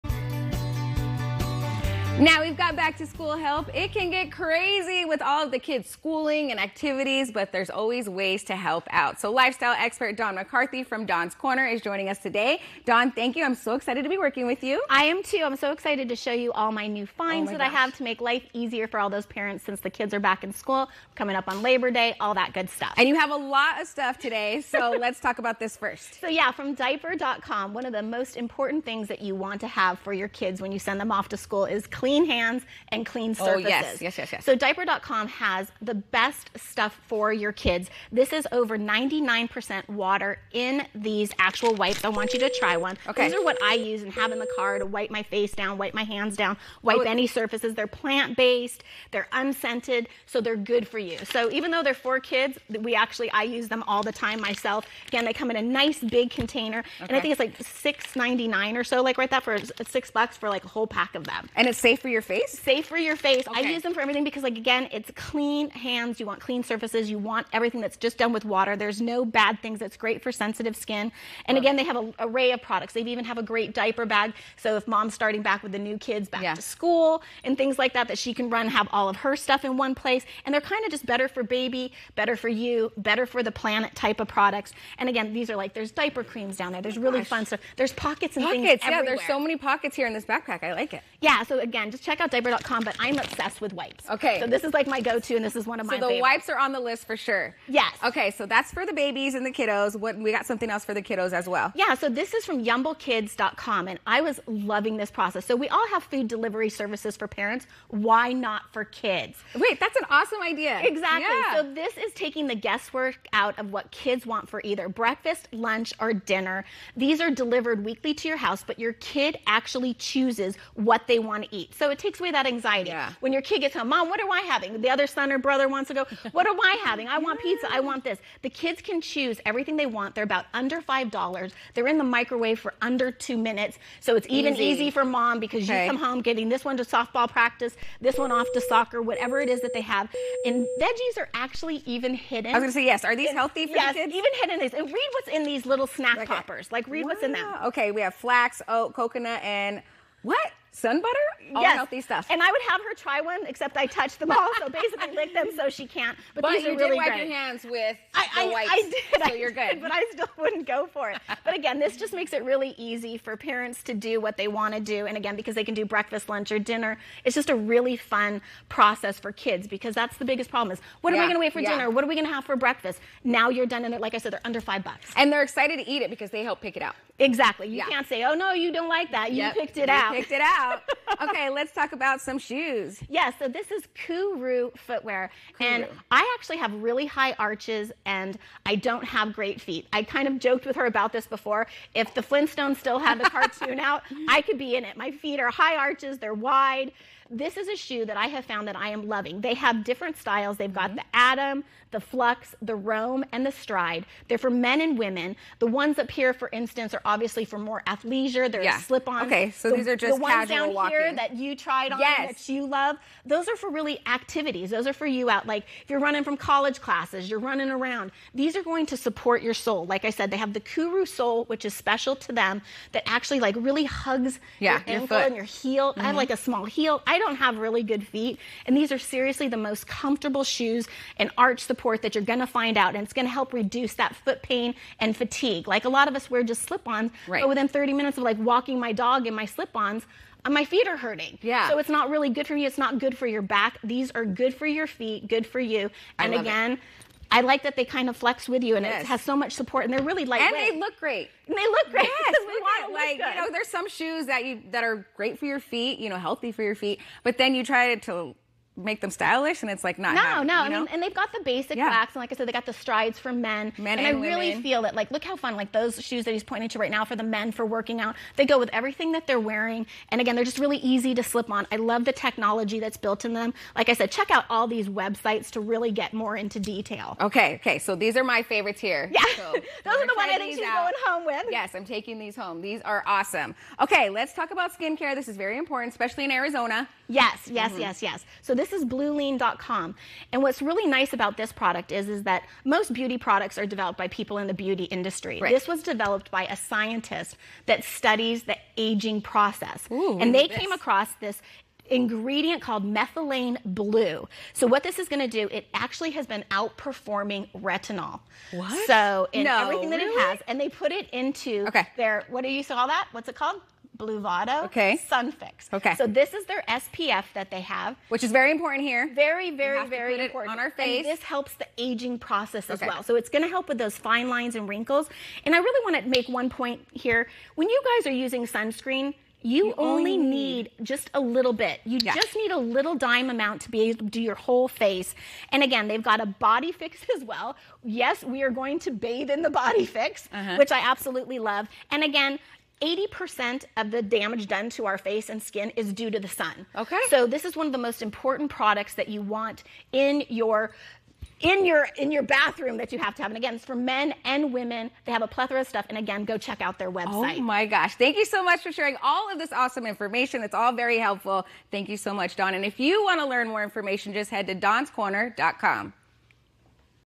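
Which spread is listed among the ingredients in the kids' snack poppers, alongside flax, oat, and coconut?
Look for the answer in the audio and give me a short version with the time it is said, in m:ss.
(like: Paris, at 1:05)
sun butter, at 2:30.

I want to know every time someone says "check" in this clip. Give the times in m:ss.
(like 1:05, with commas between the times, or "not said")
1:32, 4:34, 5:56.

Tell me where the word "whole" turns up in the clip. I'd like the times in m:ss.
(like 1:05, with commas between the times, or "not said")
1:00, 5:34.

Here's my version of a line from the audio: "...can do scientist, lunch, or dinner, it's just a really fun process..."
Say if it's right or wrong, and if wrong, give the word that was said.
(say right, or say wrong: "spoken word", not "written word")
wrong: "breakfast", not "scientist".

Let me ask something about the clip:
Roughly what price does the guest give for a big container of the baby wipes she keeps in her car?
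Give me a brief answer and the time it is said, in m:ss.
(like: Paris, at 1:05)
$6.99, at 0:57.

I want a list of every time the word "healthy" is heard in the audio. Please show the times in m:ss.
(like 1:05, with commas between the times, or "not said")
2:23, 2:31, 4:16.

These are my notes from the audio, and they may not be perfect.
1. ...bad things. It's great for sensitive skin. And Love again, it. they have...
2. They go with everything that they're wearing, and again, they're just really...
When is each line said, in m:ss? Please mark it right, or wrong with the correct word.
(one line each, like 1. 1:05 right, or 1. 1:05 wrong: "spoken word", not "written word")
1. 1:09 right
2. 4:28 right.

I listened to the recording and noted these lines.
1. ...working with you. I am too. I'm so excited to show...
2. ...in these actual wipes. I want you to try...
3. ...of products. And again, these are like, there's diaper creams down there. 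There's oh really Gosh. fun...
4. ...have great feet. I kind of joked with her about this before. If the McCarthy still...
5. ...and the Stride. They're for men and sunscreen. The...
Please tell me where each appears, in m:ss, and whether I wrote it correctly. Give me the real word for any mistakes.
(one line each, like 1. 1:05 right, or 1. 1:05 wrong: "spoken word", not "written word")
1. 0:14 right
2. 0:40 right
3. 1:24 right
4. 3:09 wrong: "Flintstones", not "McCarthy"
5. 3:23 wrong: "women", not "sunscreen".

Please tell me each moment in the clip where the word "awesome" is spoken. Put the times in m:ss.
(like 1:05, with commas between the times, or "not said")
1:50, 4:43, 5:59.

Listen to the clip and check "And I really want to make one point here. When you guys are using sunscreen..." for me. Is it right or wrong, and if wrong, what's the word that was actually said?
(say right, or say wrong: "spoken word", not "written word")
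right.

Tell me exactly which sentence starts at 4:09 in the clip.
it has so much support, and they're really lightweight.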